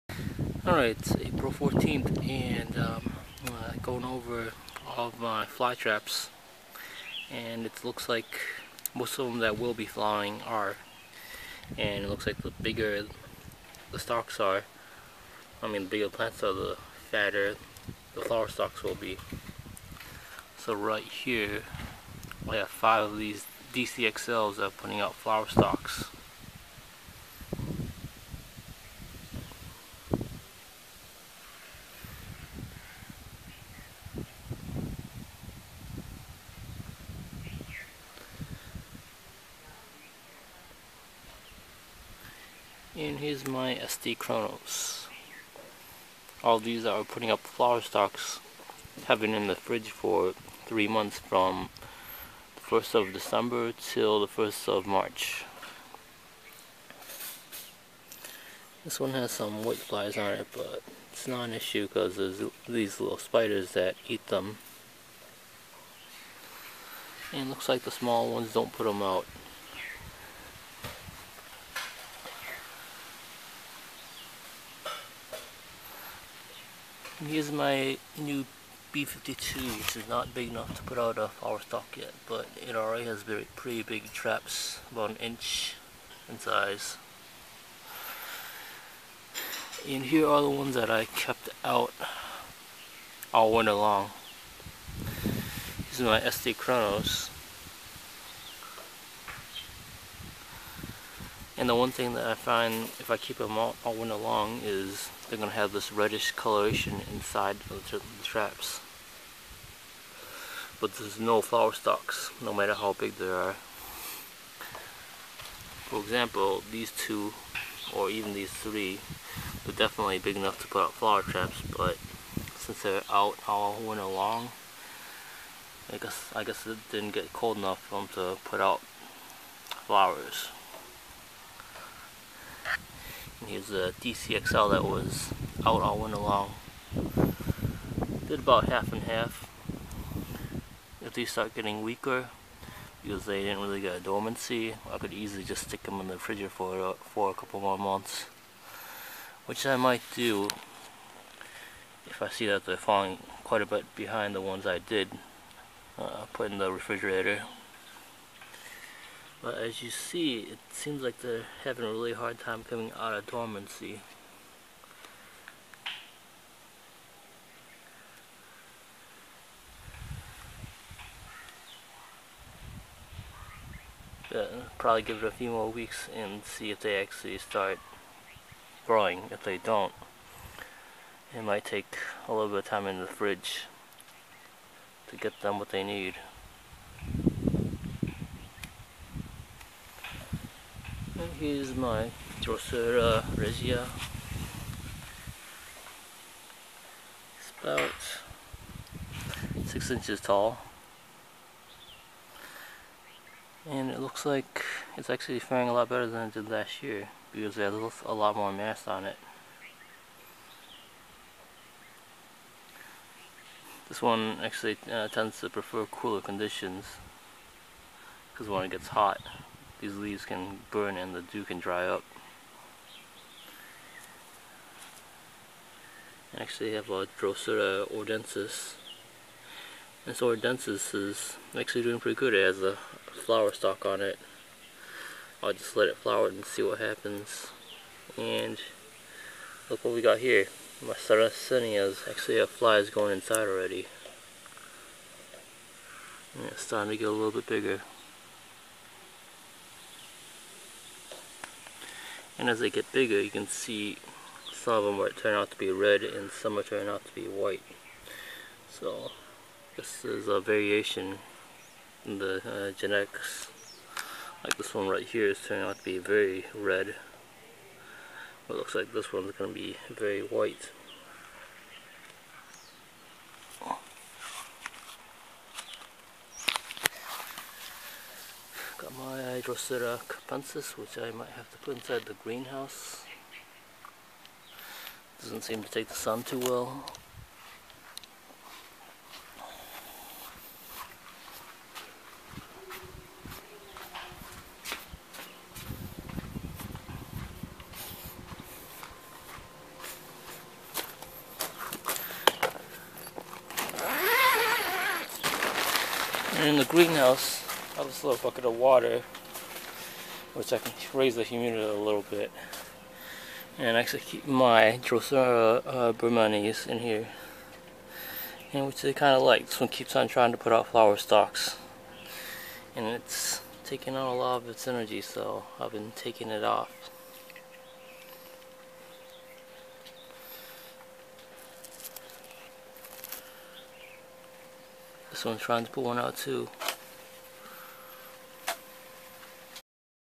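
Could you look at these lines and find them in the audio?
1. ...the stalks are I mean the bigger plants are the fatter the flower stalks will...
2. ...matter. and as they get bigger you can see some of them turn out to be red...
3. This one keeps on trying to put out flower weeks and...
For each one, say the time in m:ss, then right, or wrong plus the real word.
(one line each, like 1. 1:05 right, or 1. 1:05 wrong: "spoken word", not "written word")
1. 0:13 right
2. 4:07 wrong: "bigger", not "matter"
3. 5:19 wrong: "stalks", not "weeks".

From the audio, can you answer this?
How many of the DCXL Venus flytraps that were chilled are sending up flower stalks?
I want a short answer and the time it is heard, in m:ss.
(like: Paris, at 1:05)
5, at 0:22.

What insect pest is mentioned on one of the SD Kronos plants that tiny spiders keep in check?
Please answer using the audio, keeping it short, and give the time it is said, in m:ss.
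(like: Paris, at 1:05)
white flies, at 0:59.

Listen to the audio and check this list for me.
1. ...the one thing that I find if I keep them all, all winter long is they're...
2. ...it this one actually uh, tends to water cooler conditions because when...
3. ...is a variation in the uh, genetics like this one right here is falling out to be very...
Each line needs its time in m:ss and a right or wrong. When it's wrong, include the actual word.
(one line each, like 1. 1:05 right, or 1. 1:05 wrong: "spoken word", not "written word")
1. 1:41 right
2. 3:29 wrong: "prefer", not "water"
3. 4:20 wrong: "turning", not "falling".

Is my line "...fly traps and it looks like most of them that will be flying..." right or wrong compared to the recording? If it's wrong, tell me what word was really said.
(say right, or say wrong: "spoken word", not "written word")
right.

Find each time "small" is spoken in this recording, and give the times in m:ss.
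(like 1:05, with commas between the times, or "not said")
1:07.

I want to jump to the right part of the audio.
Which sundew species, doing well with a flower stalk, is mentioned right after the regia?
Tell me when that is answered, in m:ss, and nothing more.
3:47.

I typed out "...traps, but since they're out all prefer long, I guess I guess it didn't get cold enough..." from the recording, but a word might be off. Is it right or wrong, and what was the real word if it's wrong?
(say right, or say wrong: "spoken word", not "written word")
wrong: "winter", not "prefer".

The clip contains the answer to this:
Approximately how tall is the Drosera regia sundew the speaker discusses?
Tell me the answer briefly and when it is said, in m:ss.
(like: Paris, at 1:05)
6 inches, at 3:19.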